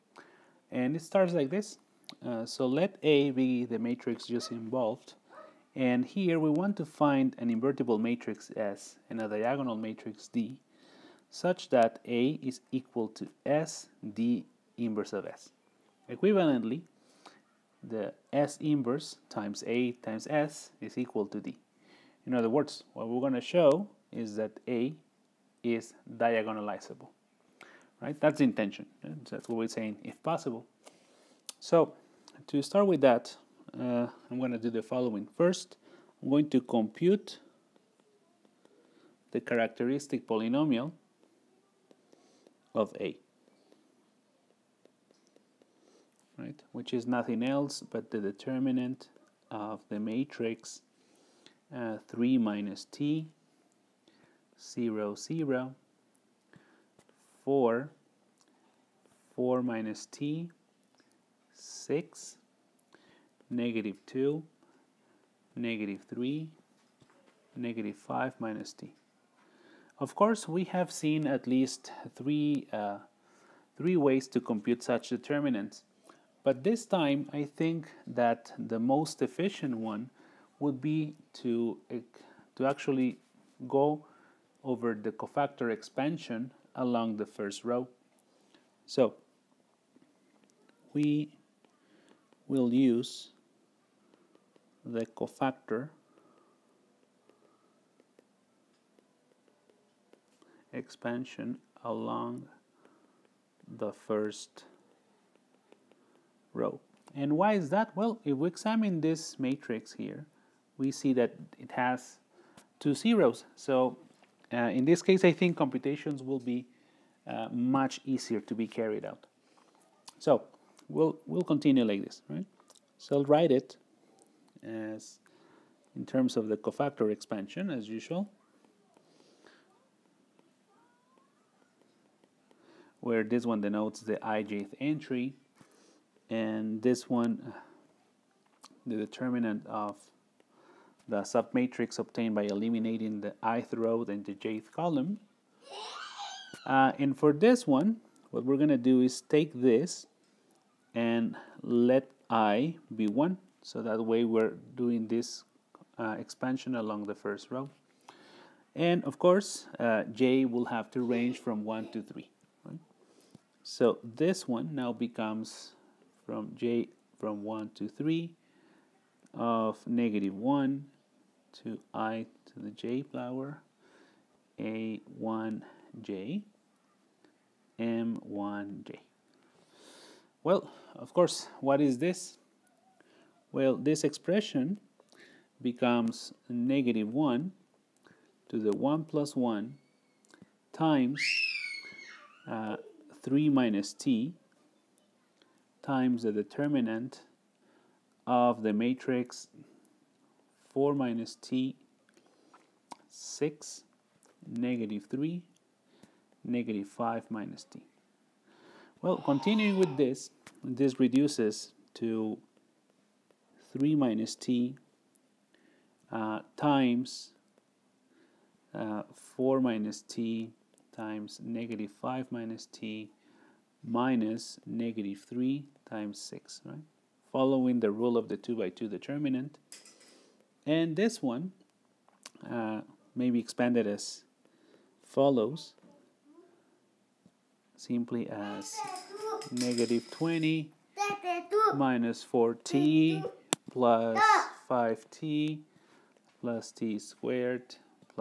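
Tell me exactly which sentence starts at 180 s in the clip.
Well, of course, what is this?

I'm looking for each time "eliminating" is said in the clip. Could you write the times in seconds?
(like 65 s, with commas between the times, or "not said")
142 s.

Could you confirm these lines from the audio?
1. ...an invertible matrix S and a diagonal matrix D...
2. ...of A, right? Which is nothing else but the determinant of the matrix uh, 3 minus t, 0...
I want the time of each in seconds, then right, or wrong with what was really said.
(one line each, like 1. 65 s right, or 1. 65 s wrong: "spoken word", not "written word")
1. 7 s right
2. 42 s right.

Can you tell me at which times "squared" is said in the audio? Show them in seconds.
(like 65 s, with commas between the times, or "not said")
246 s.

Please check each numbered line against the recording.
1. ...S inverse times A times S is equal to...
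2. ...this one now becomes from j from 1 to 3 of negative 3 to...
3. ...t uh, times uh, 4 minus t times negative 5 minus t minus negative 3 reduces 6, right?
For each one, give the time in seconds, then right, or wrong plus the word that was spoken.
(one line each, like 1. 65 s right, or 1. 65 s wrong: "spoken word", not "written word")
1. 18 s right
2. 164 s wrong: "1", not "3"
3. 214 s wrong: "times", not "reduces".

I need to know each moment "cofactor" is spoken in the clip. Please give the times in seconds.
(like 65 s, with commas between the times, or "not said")
85 s, 95 s, 126 s.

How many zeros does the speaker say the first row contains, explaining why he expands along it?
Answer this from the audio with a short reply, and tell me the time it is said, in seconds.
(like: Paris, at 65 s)
2, at 112 s.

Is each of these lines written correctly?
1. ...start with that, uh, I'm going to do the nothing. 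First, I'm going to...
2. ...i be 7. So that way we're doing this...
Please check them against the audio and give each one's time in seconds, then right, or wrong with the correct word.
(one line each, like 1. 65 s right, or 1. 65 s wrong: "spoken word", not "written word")
1. 32 s wrong: "following", not "nothing"
2. 152 s wrong: "1", not "7".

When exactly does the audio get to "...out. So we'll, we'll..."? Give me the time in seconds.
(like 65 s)
119 s.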